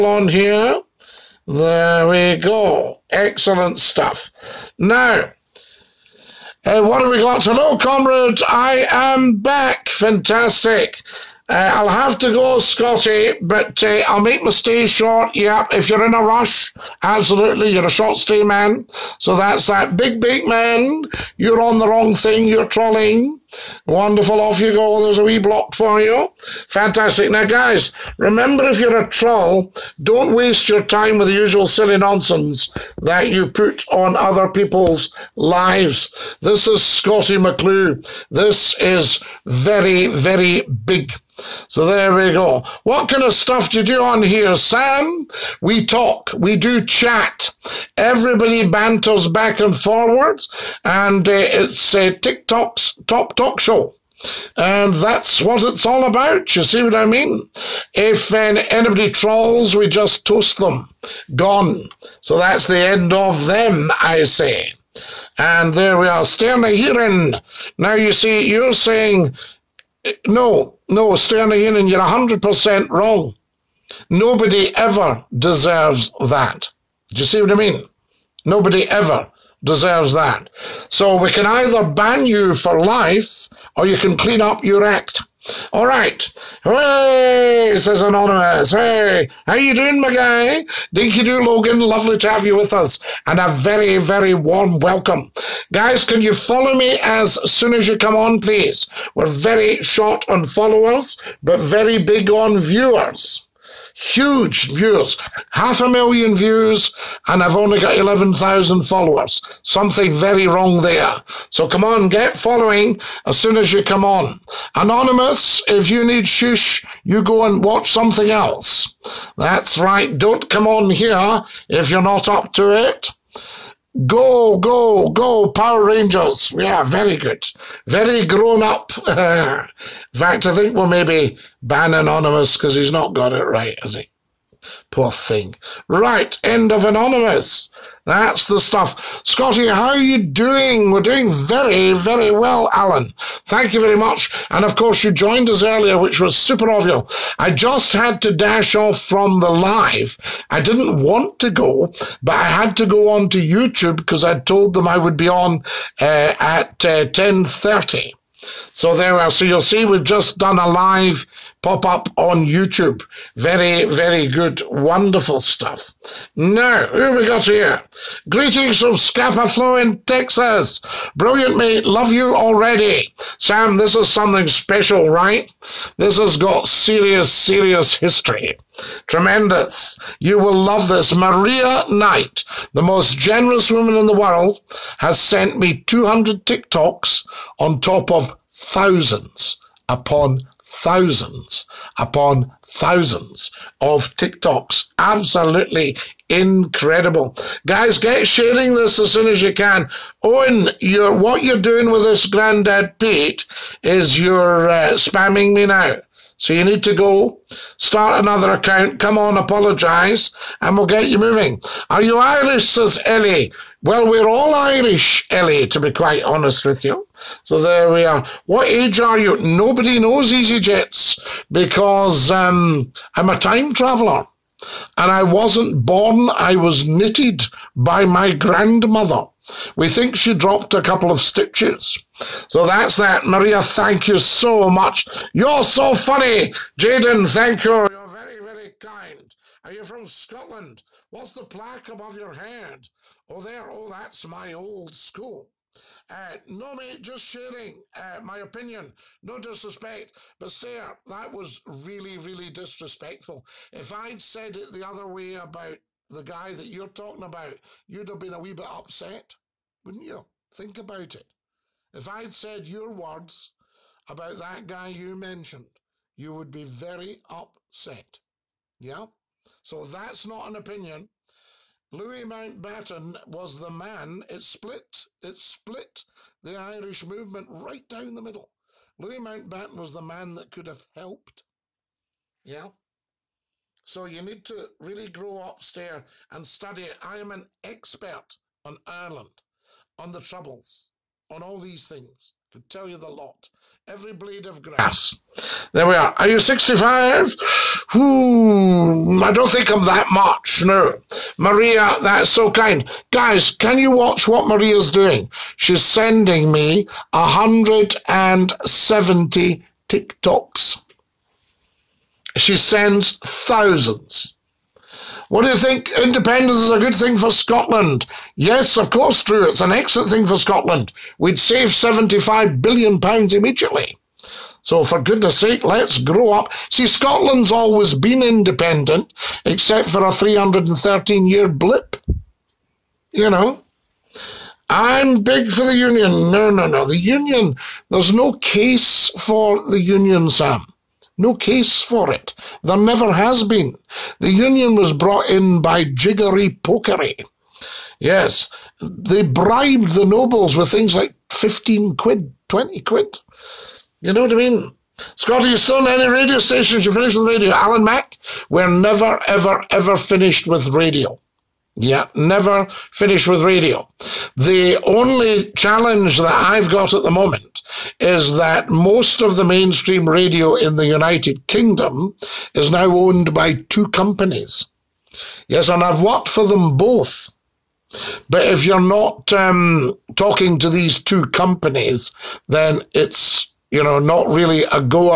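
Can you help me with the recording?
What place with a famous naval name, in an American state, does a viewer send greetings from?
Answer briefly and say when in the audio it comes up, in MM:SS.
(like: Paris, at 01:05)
Scapa Flow, at 02:48.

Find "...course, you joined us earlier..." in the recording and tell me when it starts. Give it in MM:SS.
02:24.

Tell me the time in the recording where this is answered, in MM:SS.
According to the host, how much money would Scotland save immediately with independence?
05:21.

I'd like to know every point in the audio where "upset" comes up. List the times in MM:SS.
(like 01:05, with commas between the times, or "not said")
04:18, 04:27.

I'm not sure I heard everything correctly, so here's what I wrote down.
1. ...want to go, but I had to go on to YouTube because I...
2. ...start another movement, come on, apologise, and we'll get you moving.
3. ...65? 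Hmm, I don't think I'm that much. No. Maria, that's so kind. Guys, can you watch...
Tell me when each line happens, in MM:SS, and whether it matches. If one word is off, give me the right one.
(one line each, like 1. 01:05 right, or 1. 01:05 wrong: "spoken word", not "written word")
1. 02:31 right
2. 03:27 wrong: "account", not "movement"
3. 04:56 right.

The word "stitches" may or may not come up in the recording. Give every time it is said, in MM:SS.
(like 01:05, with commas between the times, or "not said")
03:51.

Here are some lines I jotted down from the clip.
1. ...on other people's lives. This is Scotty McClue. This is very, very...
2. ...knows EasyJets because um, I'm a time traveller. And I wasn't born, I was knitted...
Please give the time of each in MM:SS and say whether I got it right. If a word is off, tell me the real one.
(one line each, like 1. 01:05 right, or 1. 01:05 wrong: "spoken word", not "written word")
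1. 00:33 right
2. 03:39 right.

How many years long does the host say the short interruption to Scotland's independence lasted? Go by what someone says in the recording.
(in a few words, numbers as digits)
313.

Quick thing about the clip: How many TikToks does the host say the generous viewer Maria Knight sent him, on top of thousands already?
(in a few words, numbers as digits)
200.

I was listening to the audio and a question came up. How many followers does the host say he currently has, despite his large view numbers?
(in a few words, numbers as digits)
11,000.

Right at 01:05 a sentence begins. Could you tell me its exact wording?
And there we are, Sterna Heeren.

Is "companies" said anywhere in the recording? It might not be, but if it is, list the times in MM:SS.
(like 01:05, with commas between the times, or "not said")
06:13, 06:21.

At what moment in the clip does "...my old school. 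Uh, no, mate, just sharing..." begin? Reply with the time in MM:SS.
04:04.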